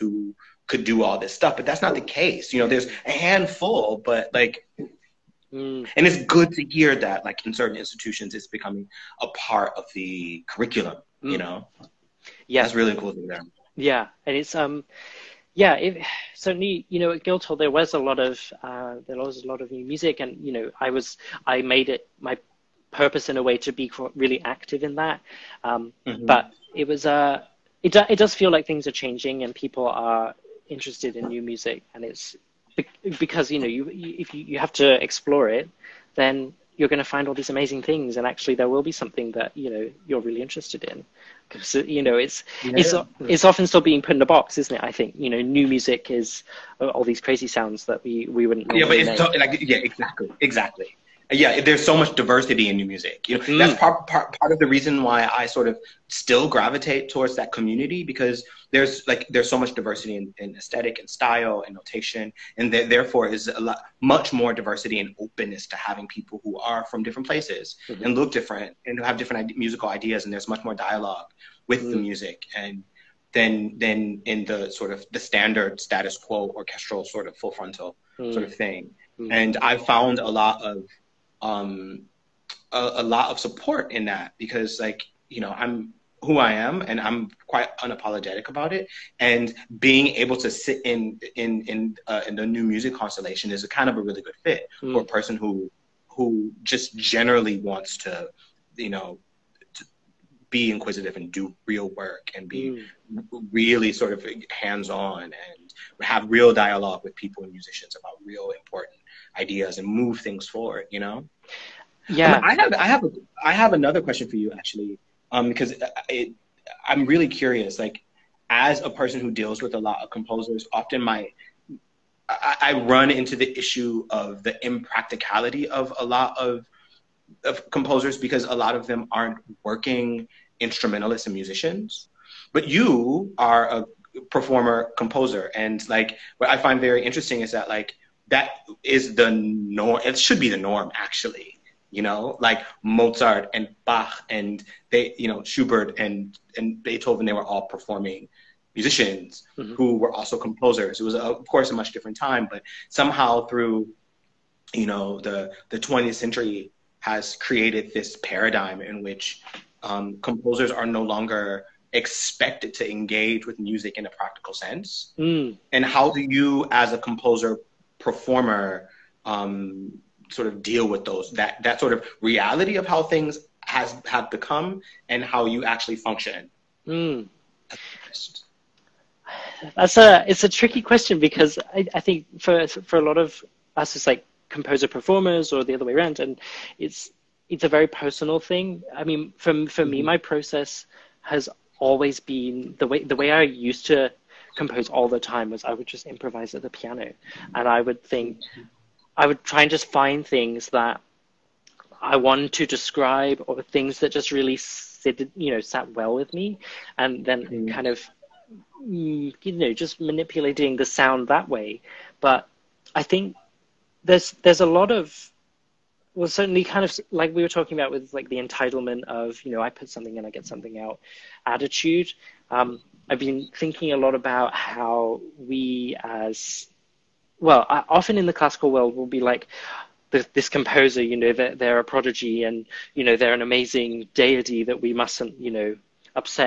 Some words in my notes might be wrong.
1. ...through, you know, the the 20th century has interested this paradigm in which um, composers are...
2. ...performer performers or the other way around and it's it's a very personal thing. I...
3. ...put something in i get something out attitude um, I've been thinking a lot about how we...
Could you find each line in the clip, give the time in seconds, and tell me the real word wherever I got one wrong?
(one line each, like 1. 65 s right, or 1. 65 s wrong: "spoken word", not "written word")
1. 153 s wrong: "created", not "interested"
2. 184 s wrong: "composer", not "performer"
3. 219 s right.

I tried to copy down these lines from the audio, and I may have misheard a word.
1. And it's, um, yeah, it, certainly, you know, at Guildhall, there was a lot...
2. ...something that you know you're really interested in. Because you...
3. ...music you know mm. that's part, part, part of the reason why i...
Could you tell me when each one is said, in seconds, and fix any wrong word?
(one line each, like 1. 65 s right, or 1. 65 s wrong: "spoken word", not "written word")
1. 14 s right
2. 38 s right
3. 52 s right.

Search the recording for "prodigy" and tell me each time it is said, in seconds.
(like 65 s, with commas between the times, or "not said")
231 s.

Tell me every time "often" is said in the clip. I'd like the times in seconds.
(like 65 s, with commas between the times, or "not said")
43 s, 120 s, 227 s.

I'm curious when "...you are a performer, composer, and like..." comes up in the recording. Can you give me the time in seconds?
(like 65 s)
132 s.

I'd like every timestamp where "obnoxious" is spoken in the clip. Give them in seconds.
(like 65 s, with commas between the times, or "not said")
not said.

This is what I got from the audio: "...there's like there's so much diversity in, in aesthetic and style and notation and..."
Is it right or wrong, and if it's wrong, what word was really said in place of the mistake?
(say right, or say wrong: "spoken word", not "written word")
right.